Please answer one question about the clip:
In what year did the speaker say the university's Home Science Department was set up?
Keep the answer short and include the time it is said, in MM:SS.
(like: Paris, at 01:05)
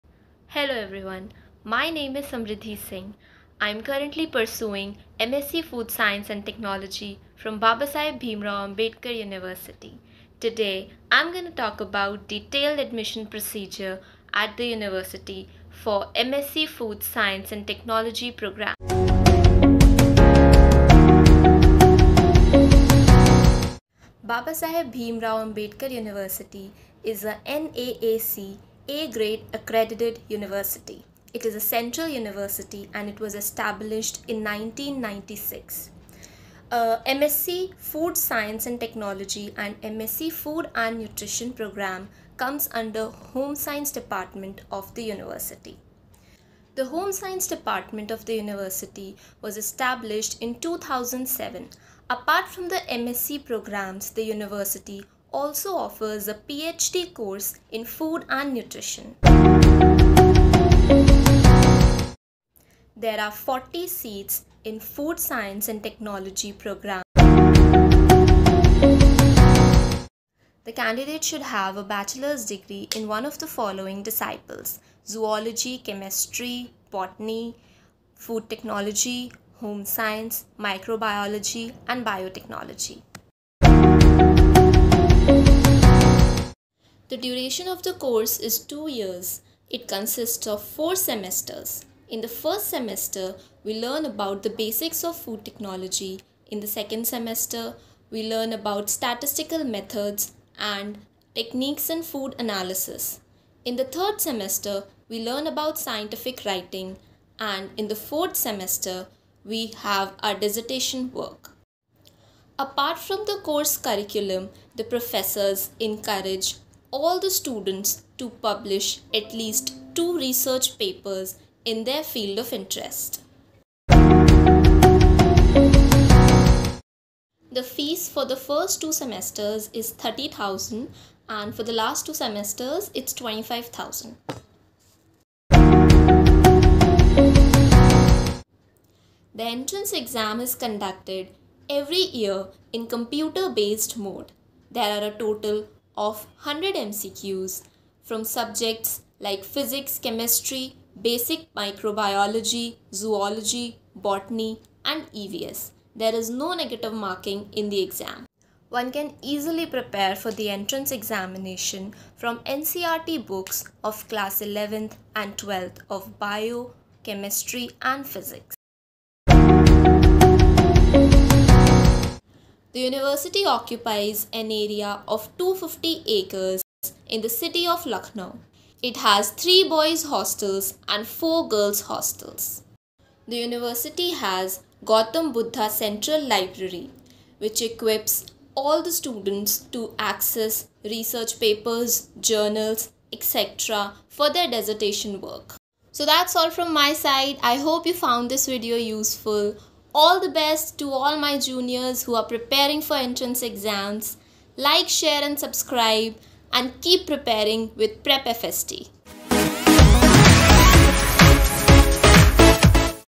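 2007, at 00:50.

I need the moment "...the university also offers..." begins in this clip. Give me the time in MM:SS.
00:54.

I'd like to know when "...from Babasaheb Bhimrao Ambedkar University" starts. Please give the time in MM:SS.
00:07.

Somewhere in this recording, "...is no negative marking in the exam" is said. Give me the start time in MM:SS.
02:36.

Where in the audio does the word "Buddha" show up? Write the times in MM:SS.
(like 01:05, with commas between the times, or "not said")
03:05.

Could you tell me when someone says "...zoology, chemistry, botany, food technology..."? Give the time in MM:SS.
01:15.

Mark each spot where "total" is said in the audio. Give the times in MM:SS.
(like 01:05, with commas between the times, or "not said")
02:25.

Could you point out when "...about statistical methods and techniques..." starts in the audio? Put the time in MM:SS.
01:38.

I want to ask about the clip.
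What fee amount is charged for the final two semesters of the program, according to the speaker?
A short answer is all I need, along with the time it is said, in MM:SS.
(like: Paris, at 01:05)
25,000, at 02:13.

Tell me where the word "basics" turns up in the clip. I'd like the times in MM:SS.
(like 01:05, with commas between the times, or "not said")
01:34, 02:31.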